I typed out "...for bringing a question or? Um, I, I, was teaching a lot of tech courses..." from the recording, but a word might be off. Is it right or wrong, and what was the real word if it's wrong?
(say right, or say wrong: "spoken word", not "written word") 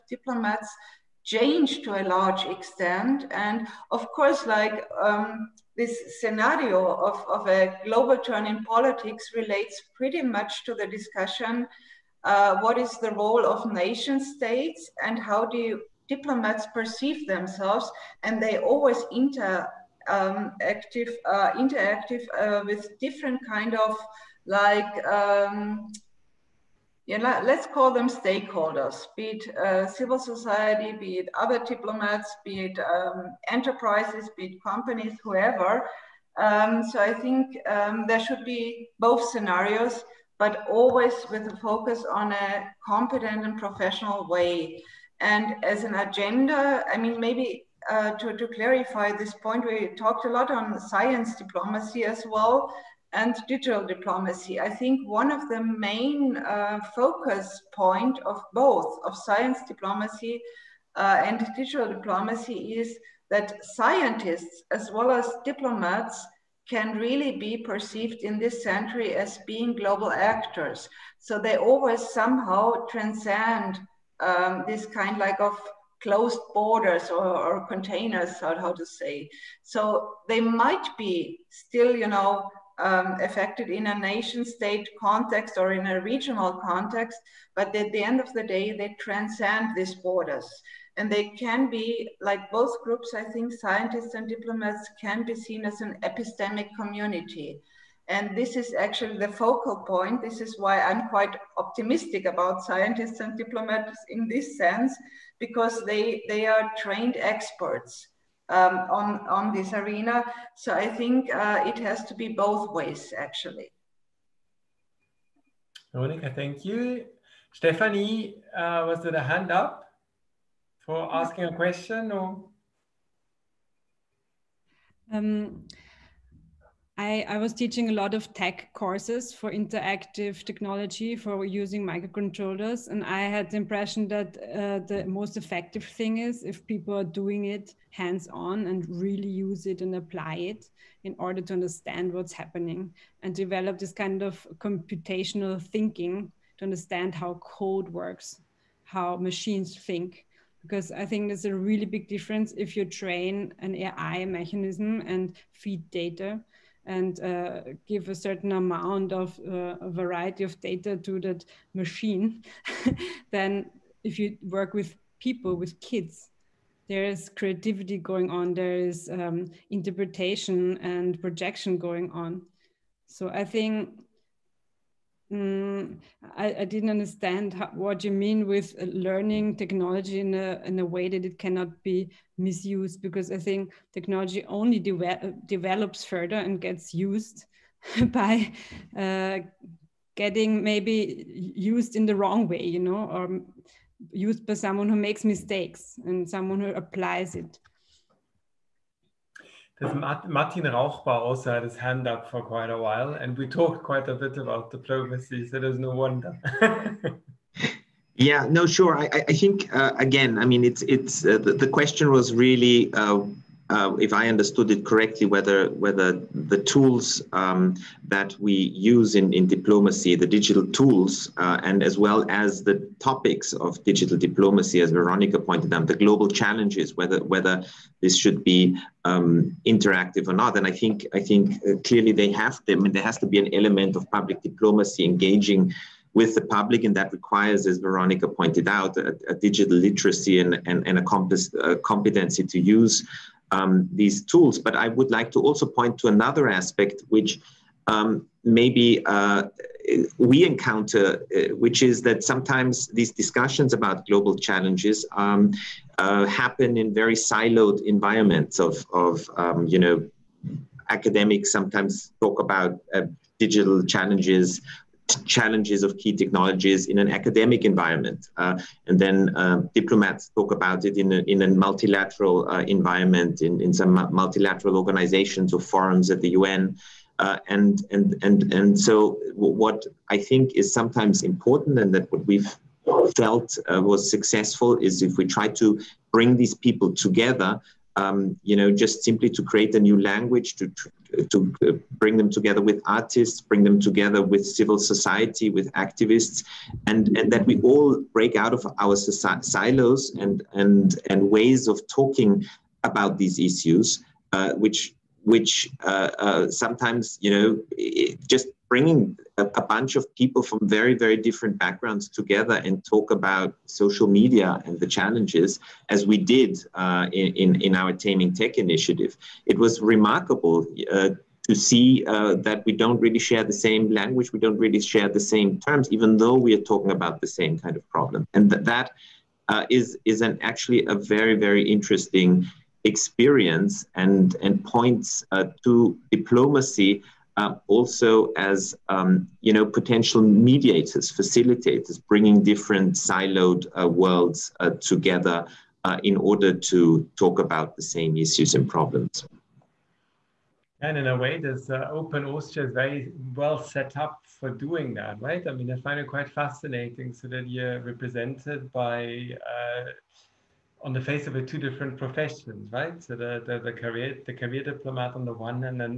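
wrong: "asking", not "bringing".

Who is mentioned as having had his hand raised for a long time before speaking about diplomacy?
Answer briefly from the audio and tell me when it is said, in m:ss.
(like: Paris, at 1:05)
Martin Rauchbauer, at 3:19.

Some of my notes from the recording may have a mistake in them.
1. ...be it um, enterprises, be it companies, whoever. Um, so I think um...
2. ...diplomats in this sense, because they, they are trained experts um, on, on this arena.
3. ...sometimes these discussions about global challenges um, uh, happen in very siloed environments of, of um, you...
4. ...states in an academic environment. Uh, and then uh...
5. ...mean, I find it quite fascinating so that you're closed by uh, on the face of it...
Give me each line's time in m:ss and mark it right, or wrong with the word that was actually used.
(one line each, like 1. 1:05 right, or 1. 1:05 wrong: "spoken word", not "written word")
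1. 0:32 right
2. 1:43 right
3. 4:12 right
4. 4:26 wrong: "technologies", not "states"
5. 5:55 wrong: "represented", not "closed".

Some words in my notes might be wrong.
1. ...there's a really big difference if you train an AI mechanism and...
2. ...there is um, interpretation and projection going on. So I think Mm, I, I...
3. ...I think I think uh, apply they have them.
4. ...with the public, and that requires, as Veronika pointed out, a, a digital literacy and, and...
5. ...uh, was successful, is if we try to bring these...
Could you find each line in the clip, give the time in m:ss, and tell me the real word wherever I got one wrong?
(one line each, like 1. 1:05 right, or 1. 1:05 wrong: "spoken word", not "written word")
1. 2:31 right
2. 2:48 right
3. 3:50 wrong: "clearly", not "apply"
4. 3:56 right
5. 4:43 right.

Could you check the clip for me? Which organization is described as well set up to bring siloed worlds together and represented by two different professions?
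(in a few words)
Open Austria.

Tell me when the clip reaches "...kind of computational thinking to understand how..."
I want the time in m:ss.
2:23.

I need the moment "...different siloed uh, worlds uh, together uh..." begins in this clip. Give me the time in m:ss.
5:42.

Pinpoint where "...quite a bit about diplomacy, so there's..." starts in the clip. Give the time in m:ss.
3:23.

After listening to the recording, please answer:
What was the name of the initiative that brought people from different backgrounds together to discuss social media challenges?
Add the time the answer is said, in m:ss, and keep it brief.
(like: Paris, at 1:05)
Taming Tech, at 5:17.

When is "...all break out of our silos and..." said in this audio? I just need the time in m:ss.
4:57.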